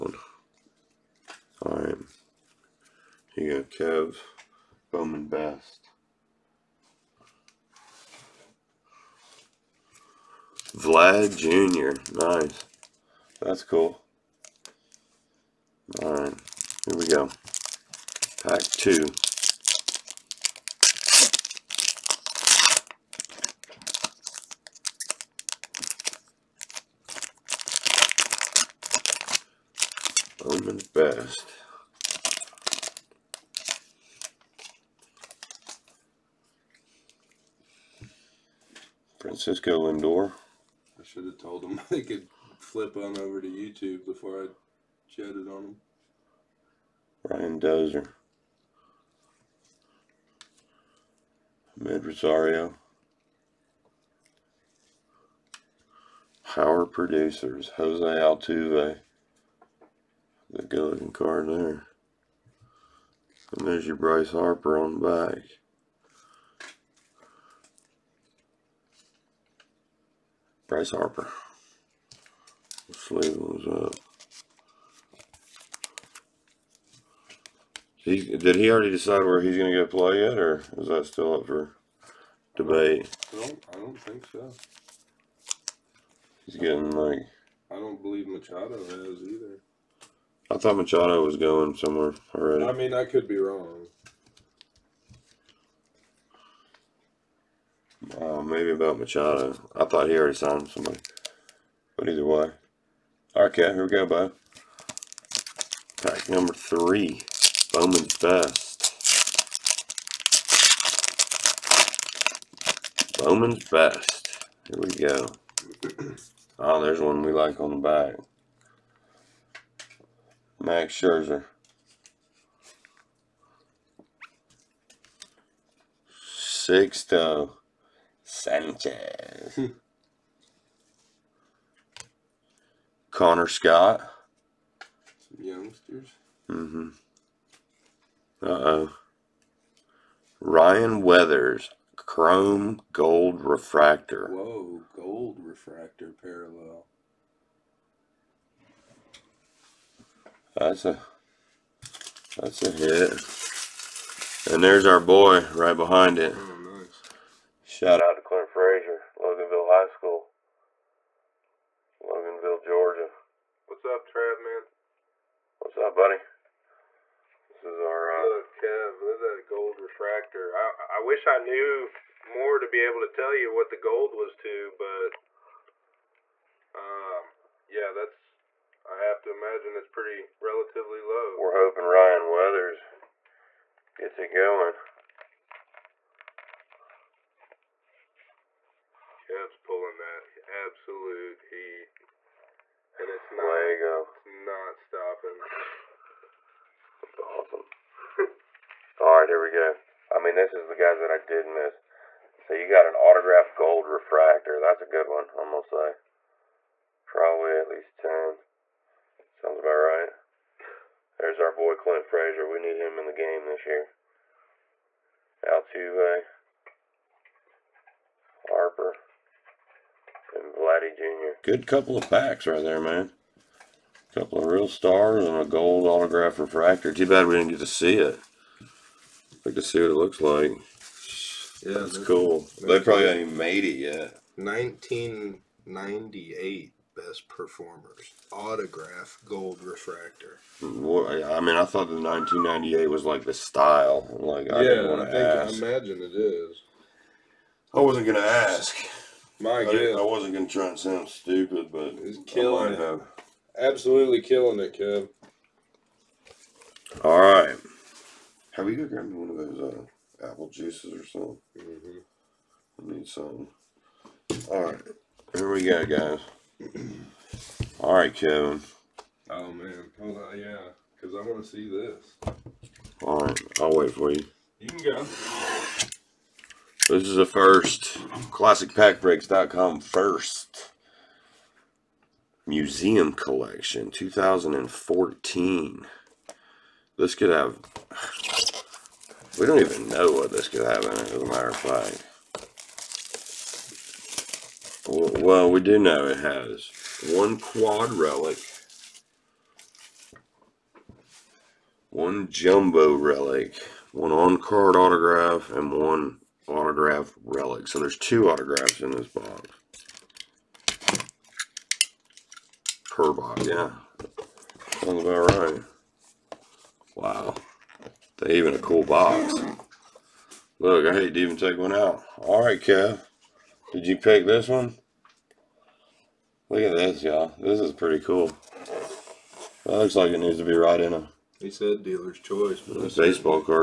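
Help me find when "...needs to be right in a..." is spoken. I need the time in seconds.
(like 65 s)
330 s.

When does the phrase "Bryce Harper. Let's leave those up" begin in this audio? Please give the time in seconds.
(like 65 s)
70 s.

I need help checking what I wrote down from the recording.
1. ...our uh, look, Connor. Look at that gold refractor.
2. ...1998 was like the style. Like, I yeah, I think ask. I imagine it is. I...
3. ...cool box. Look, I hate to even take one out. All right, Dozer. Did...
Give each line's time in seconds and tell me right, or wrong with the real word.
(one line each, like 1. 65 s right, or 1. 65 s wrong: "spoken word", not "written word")
1. 167 s wrong: "Kev", not "Connor"
2. 242 s right
3. 318 s wrong: "Kev", not "Dozer".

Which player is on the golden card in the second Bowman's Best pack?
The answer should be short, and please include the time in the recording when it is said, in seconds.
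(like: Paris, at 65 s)
Jose Altuve, at 57 s.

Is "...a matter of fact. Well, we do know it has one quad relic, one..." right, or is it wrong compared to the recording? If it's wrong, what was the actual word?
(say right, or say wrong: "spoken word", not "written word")
right.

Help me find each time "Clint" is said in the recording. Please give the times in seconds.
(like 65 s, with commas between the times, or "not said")
158 s, 211 s.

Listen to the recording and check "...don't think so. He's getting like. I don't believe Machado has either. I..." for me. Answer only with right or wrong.
right.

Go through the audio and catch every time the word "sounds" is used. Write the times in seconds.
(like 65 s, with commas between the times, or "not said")
209 s, 250 s, 314 s.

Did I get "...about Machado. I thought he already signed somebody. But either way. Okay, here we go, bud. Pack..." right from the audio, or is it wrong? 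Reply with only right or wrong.
right.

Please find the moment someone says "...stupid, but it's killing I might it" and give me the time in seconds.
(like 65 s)
251 s.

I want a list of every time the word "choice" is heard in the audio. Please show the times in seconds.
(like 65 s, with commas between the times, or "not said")
332 s.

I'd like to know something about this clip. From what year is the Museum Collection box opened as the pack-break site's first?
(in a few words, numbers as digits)
2014.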